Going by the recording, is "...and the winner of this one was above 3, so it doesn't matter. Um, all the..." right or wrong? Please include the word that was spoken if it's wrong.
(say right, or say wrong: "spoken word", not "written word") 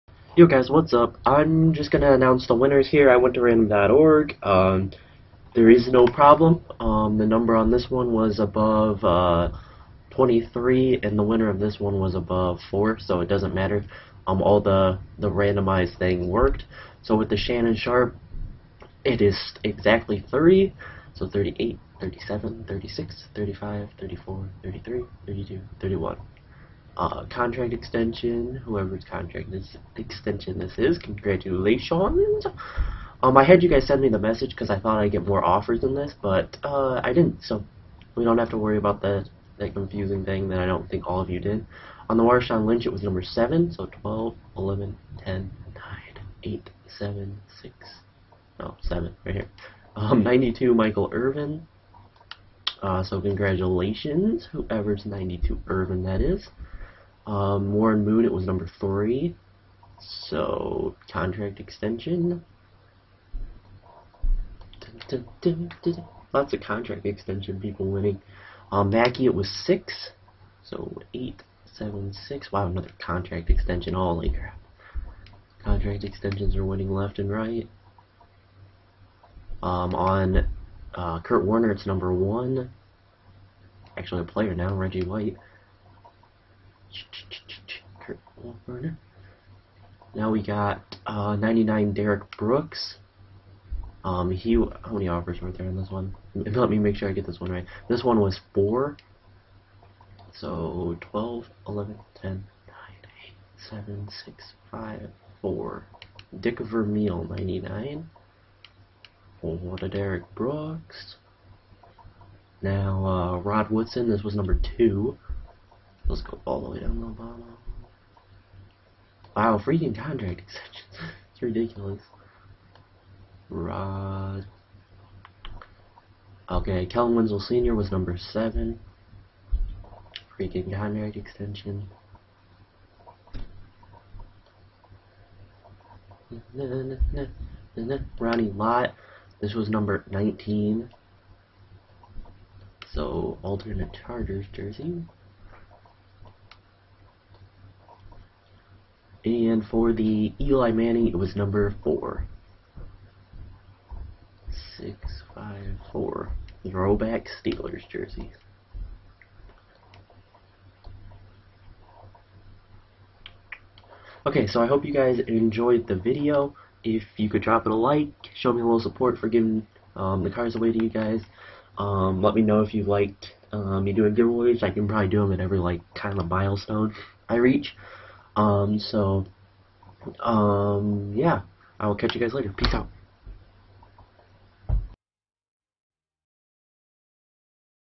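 wrong: "4", not "3".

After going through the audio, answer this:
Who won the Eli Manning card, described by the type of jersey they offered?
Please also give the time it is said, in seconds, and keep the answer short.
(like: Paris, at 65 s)
Throwback Steelers jersey, at 156 s.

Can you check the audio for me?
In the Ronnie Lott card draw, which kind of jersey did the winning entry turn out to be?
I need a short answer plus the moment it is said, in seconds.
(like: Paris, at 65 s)
Alternate Chargers jersey, at 143 s.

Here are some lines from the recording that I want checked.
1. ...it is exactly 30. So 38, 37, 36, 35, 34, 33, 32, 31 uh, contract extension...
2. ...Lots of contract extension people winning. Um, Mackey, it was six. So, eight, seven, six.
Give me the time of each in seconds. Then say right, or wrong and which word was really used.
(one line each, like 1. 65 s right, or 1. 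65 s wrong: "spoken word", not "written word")
1. 19 s right
2. 66 s right.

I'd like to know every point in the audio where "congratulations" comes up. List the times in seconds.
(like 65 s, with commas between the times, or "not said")
30 s, 53 s.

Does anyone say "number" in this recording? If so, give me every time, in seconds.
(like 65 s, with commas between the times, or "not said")
7 s, 43 s, 58 s, 81 s, 114 s, 127 s, 139 s, 151 s.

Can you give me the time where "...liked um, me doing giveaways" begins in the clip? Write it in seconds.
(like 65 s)
172 s.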